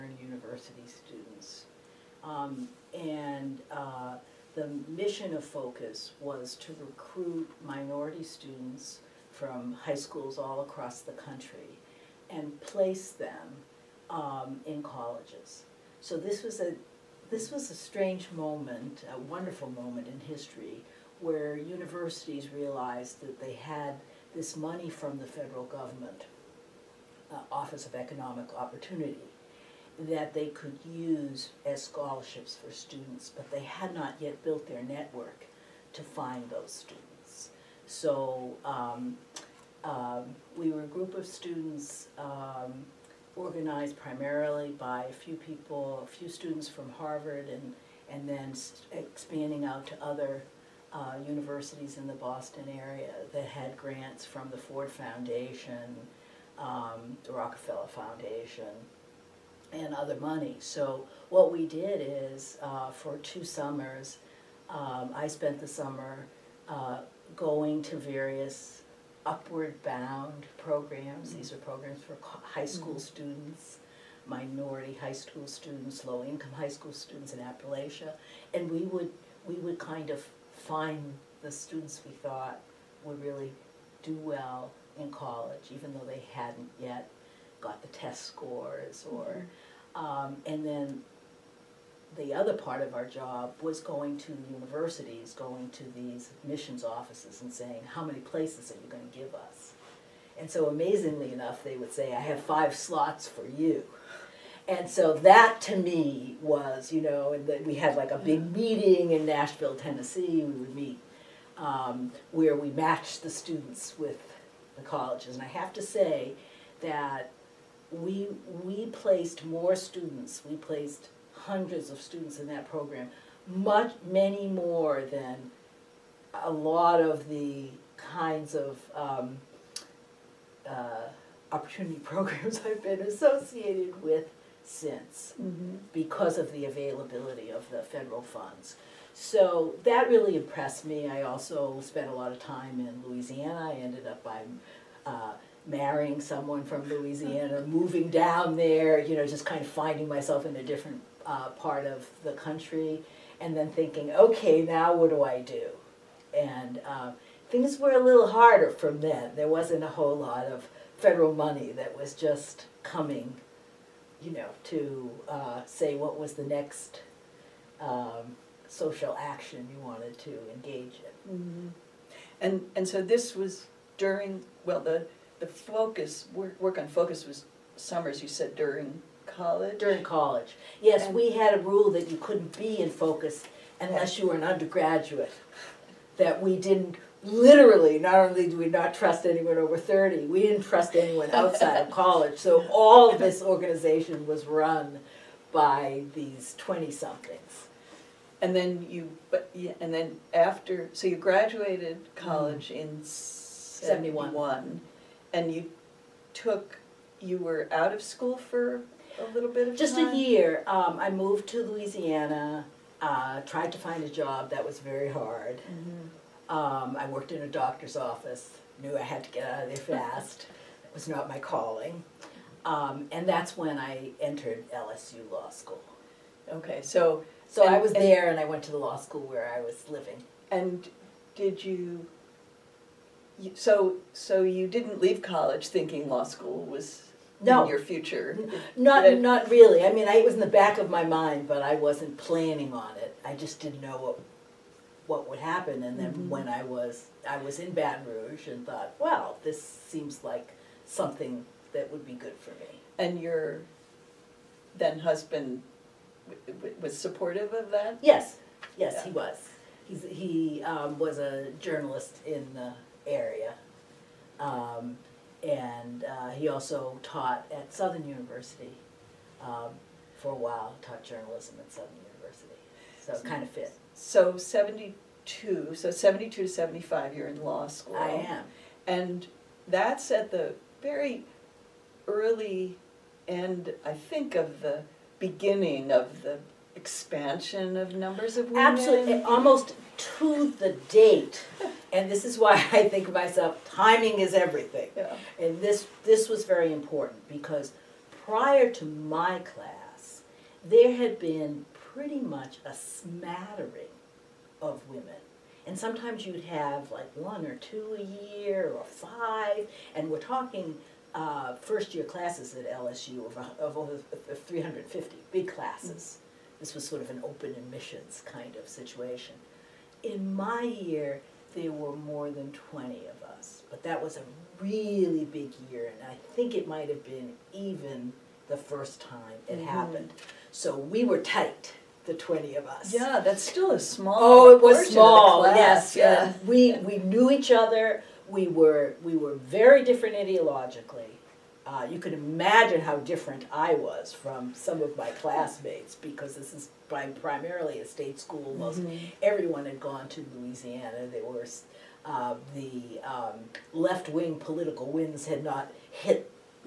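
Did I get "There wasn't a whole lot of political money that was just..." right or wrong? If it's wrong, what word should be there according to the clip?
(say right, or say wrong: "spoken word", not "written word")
wrong: "federal", not "political".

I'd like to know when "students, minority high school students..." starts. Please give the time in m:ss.
1:13.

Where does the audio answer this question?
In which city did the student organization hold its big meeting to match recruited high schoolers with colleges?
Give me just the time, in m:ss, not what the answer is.
1:49.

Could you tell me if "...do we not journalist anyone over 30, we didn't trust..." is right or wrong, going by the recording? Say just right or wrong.
wrong.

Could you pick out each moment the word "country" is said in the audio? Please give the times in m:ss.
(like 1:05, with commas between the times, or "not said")
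0:11, 2:32.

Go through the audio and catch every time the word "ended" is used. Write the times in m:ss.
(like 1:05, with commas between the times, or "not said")
2:23.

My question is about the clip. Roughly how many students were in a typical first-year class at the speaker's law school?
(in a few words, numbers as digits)
350.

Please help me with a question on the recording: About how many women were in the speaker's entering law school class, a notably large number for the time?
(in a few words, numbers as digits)
more than 20.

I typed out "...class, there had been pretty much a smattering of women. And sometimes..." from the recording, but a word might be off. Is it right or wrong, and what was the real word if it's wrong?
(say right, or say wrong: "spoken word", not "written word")
right.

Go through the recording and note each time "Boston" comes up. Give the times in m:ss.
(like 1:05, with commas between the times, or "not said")
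0:52.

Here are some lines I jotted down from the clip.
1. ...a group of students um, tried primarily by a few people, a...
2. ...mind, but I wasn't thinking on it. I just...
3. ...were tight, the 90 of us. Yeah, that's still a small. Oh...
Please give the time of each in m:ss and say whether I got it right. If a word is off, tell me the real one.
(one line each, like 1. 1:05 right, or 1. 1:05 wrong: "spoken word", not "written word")
1. 0:40 wrong: "organized", not "tried"
2. 4:01 wrong: "planning", not "thinking"
3. 5:31 wrong: "20", not "90".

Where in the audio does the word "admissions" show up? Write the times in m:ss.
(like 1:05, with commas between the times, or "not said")
1:36, 5:17.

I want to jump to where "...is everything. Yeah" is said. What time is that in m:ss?
4:54.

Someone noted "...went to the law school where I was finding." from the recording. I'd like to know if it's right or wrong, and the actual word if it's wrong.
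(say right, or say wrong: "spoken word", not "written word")
wrong: "living", not "finding".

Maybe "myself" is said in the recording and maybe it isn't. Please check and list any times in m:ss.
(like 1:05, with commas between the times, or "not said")
2:30, 4:53.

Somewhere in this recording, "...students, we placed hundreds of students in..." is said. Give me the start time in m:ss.
1:59.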